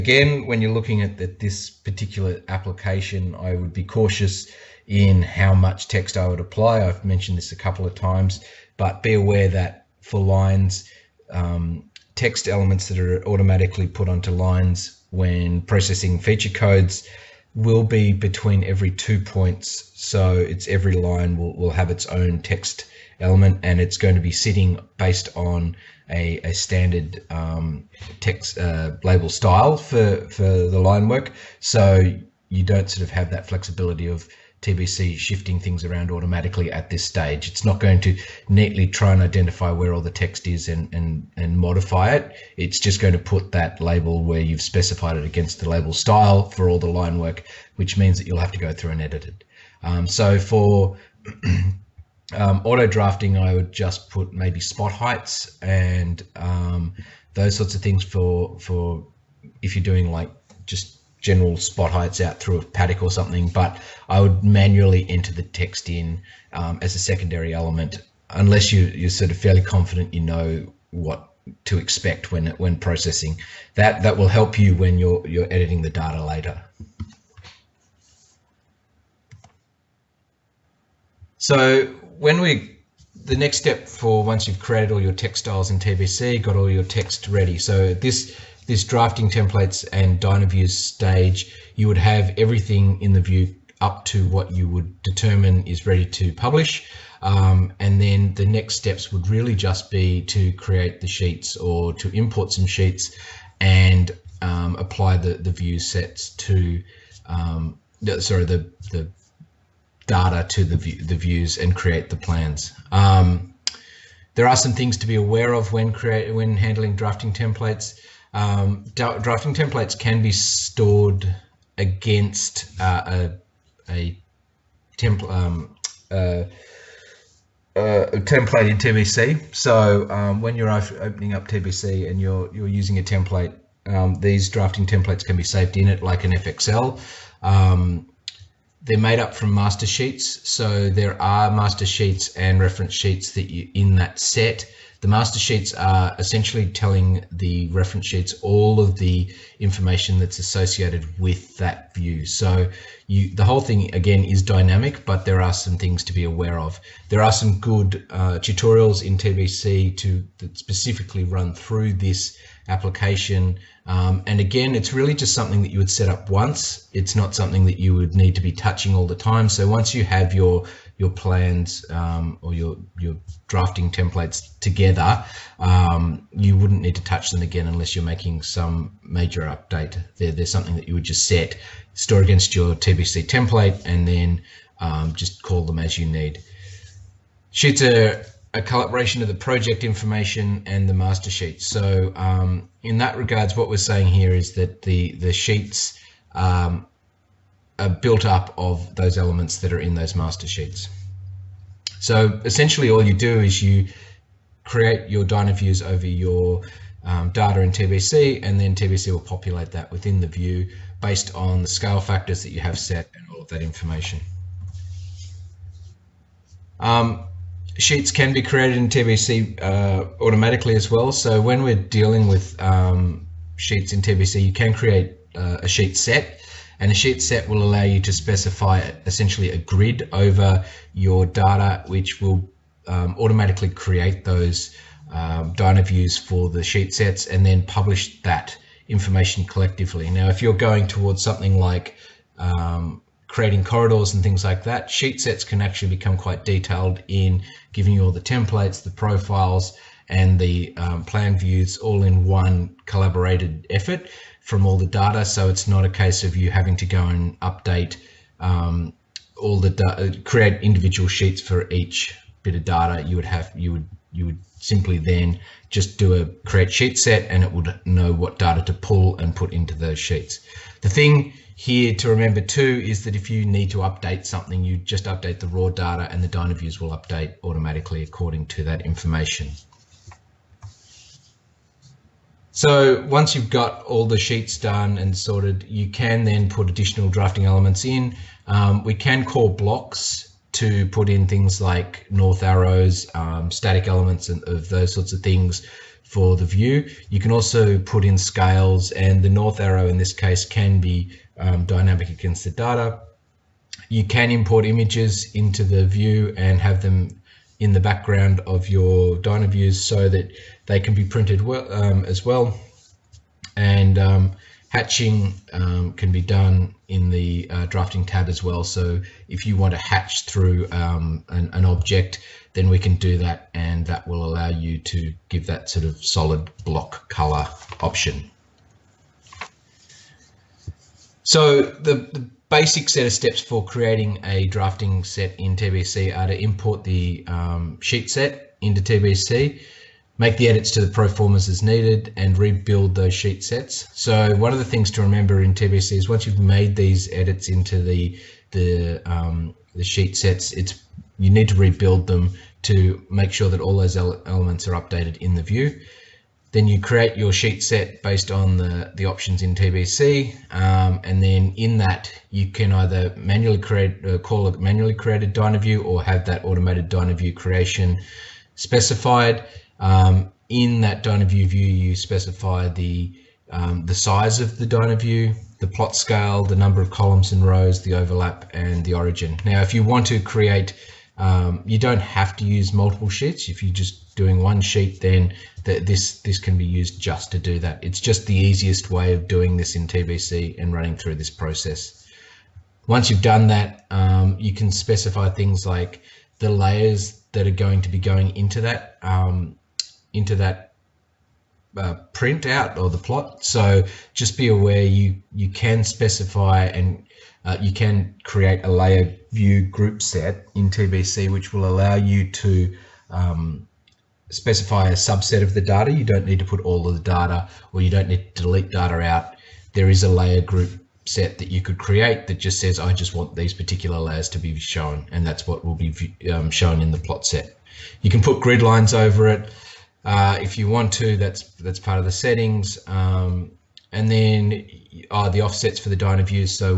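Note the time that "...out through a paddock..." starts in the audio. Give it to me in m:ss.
1:02.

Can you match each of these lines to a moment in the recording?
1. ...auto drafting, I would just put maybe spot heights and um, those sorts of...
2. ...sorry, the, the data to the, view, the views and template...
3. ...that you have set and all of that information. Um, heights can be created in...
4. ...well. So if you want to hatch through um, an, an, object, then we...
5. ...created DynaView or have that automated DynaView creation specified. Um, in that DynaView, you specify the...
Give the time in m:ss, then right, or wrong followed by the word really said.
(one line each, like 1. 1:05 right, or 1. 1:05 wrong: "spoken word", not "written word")
1. 0:52 right
2. 1:48 wrong: "create", not "template"
3. 3:32 wrong: "sheets", not "heights"
4. 5:18 right
5. 6:04 right.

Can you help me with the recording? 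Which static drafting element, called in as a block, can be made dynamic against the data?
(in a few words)
North arrow.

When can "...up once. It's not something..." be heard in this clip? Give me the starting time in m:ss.
2:46.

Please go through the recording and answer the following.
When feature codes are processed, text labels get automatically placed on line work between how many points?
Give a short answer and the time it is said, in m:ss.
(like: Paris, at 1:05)
2, at 0:18.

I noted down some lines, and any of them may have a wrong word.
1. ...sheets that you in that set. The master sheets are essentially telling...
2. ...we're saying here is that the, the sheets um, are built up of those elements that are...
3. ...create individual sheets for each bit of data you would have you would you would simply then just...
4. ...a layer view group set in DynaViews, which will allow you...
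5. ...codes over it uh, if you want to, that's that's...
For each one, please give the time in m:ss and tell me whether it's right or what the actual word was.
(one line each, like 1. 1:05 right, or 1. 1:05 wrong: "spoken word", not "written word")
1. 2:22 right
2. 3:13 right
3. 4:20 right
4. 6:48 wrong: "TBC", not "DynaViews"
5. 7:08 wrong: "lines", not "codes".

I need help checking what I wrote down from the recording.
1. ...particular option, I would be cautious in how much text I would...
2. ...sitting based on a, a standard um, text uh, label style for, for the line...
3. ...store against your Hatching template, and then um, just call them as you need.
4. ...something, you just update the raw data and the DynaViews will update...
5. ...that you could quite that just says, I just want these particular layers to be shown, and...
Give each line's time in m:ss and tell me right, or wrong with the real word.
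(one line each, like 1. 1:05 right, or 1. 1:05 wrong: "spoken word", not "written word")
1. 0:01 wrong: "application", not "option"
2. 0:24 right
3. 3:01 wrong: "TBC", not "Hatching"
4. 4:34 right
5. 7:01 wrong: "create", not "quite".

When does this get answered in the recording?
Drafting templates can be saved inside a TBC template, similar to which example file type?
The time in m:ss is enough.
2:16.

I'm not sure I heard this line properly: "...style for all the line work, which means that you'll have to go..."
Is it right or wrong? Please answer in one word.
right.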